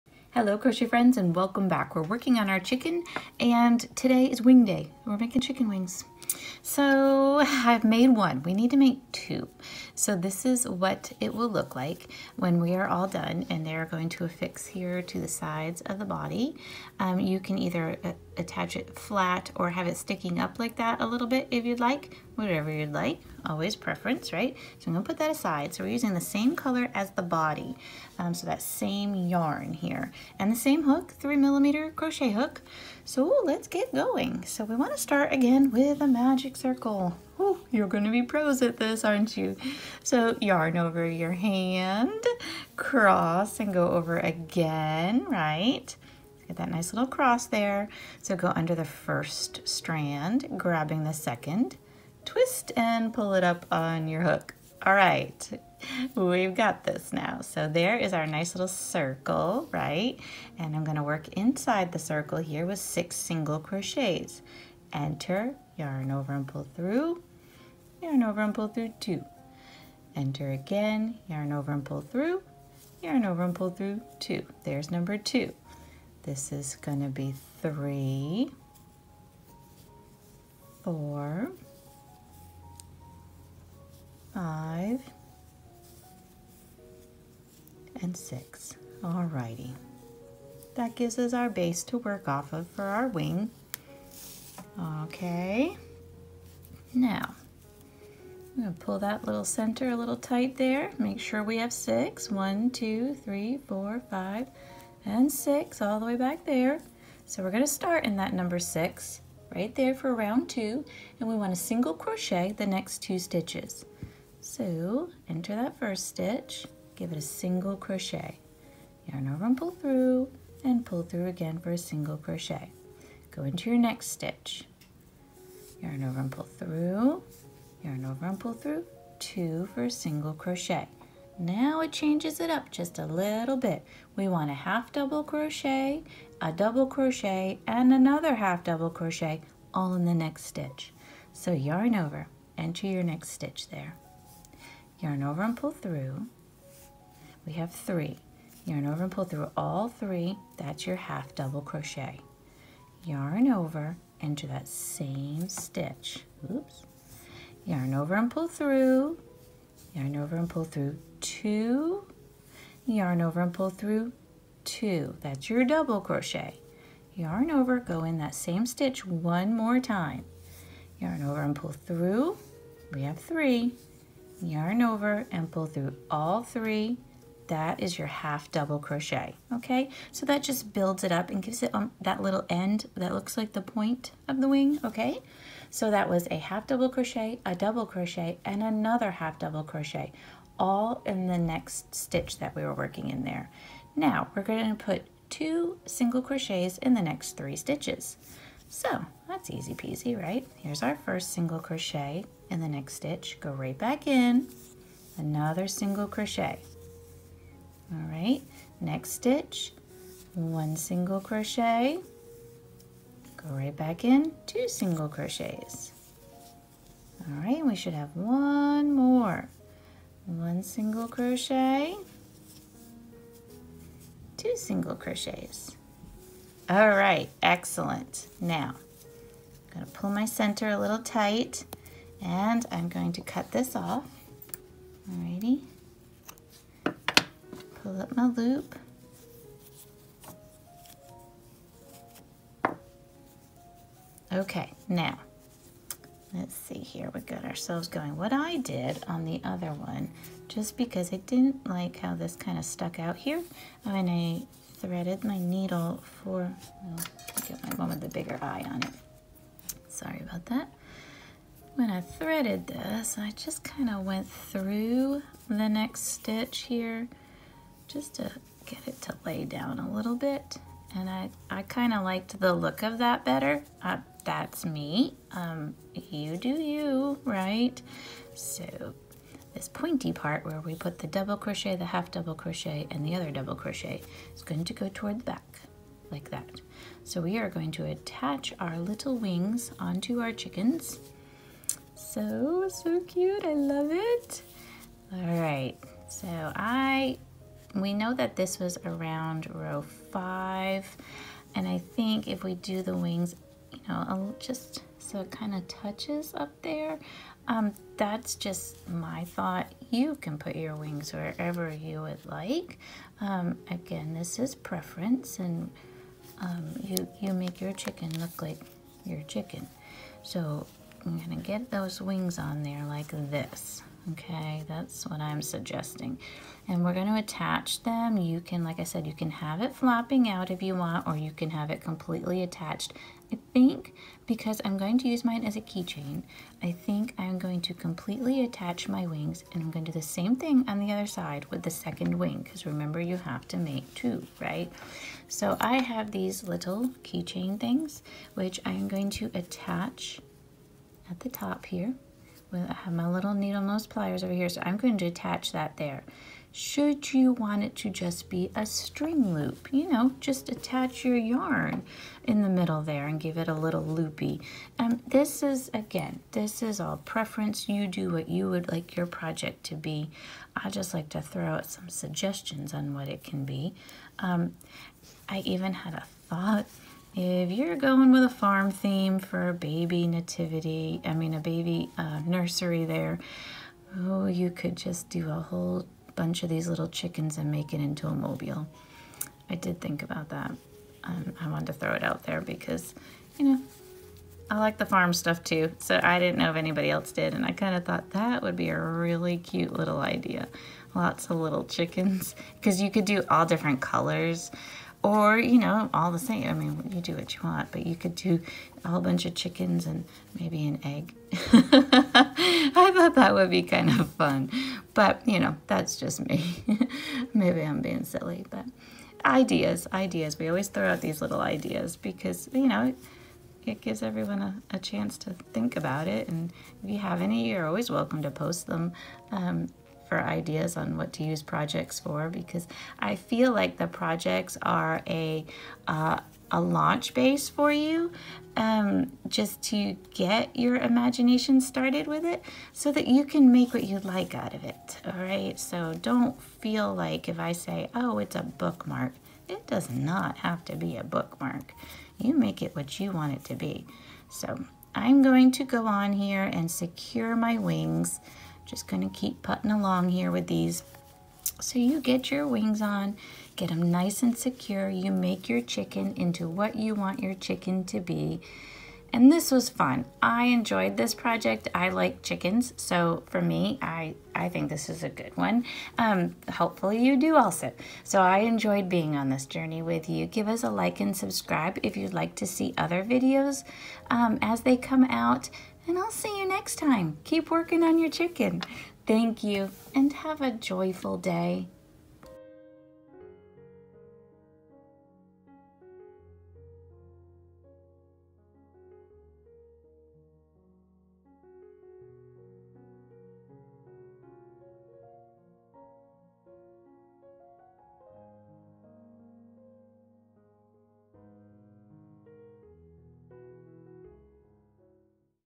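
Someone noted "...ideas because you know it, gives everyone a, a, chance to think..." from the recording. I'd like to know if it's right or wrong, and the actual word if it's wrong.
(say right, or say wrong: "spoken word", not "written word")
right.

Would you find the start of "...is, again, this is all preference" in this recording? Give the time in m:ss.
6:05.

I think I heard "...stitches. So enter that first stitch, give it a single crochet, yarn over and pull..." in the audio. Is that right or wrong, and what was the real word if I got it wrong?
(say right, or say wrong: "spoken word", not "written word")
right.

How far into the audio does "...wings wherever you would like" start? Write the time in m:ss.
5:10.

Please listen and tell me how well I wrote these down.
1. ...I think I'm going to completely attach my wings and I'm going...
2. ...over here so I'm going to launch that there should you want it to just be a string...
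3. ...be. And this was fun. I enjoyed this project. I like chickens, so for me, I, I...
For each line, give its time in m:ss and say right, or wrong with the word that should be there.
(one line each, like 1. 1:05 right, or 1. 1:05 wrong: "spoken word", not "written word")
1. 5:36 right
2. 5:54 wrong: "attach", not "launch"
3. 7:47 right.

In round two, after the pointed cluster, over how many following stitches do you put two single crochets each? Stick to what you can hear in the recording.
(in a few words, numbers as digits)
3.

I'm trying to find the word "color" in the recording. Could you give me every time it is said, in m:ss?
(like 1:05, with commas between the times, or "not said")
0:26, 6:43.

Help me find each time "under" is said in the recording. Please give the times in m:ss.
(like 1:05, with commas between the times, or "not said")
0:48.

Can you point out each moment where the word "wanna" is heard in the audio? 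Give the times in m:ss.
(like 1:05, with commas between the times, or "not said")
0:34, 1:51.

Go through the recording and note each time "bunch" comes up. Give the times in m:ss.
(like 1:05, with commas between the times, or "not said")
6:26, 6:49.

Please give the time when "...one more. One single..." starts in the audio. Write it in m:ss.
3:38.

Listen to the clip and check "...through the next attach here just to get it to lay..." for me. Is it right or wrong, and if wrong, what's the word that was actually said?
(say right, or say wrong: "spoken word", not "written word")
wrong: "stitch", not "attach".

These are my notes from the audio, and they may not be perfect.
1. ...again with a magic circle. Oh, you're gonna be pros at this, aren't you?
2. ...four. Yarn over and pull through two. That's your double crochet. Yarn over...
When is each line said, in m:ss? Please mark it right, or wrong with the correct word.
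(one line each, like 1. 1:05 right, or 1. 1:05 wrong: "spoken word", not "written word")
1. 0:35 right
2. 2:41 wrong: "two", not "four".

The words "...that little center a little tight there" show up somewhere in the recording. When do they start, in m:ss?
1:38.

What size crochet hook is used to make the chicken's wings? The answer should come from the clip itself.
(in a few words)
3 millimeter.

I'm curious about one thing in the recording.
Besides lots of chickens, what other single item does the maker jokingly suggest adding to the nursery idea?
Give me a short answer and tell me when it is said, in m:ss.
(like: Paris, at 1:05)
an egg, at 6:50.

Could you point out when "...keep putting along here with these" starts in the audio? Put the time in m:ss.
7:39.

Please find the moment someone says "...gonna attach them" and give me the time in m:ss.
5:26.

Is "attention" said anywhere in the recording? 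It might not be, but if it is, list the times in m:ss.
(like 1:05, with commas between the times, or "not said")
not said.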